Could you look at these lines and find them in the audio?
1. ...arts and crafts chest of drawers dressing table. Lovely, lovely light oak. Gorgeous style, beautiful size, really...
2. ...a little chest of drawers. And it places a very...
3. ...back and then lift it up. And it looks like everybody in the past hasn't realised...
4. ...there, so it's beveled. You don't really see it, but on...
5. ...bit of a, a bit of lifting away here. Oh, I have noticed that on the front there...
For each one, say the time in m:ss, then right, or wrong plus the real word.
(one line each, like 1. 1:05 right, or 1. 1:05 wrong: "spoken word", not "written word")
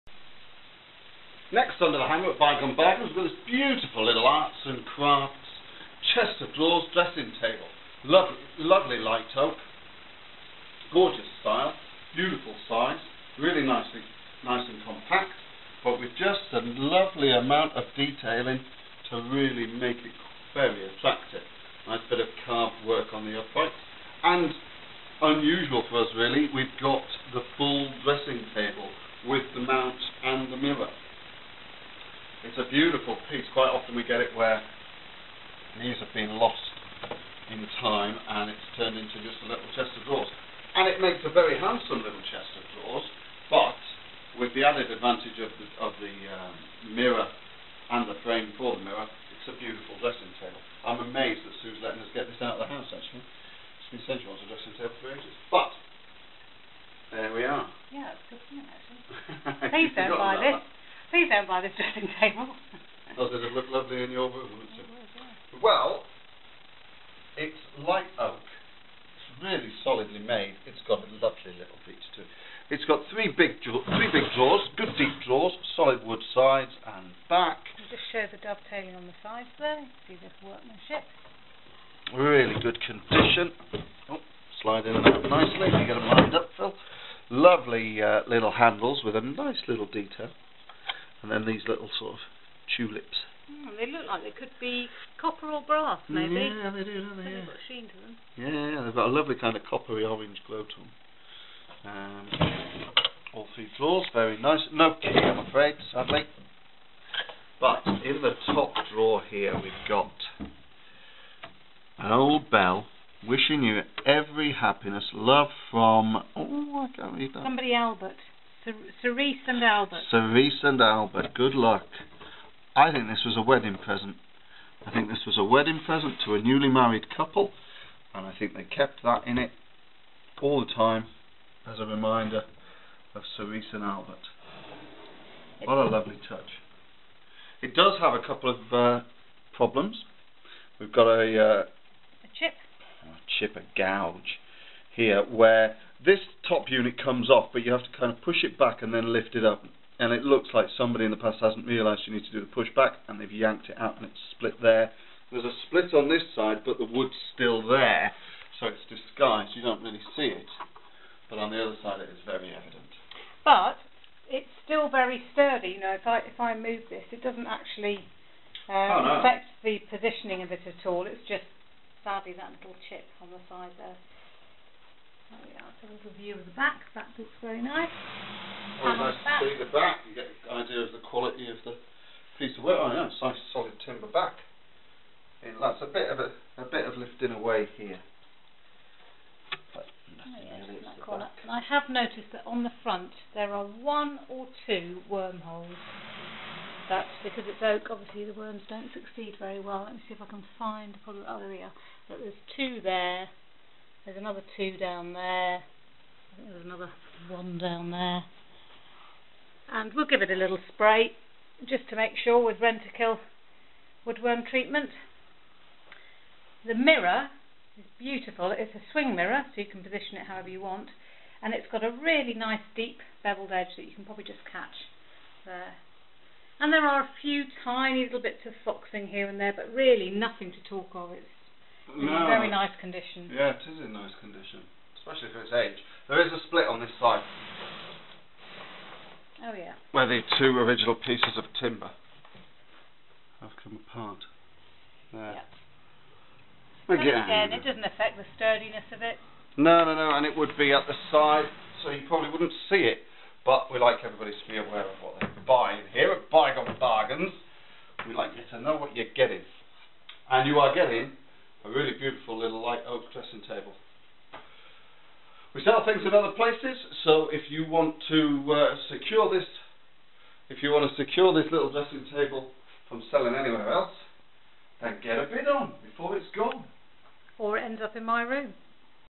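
1. 0:04 right
2. 0:39 wrong: "makes", not "places"
3. 2:28 wrong: "somebody", not "everybody"
4. 2:37 wrong: "disguised", not "beveled"
5. 3:05 right.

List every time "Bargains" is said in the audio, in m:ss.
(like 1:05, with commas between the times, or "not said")
0:02, 4:16.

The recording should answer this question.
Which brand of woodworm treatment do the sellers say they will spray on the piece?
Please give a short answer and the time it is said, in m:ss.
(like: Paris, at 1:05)
Rentokil, at 3:32.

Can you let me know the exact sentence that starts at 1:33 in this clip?
Mm, they look like they could be copper or brass, maybe.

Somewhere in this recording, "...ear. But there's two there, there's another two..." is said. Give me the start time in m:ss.
3:21.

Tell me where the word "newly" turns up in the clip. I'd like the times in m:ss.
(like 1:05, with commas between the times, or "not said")
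2:06.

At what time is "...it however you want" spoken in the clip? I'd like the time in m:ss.
3:40.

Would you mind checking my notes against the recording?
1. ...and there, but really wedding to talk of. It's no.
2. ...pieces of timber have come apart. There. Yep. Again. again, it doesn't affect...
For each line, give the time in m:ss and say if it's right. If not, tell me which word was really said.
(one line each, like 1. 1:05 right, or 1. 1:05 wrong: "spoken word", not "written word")
1. 3:49 wrong: "nothing", not "wedding"
2. 4:00 right.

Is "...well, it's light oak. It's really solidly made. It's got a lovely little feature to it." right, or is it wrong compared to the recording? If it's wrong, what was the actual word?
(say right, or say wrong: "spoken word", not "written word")
right.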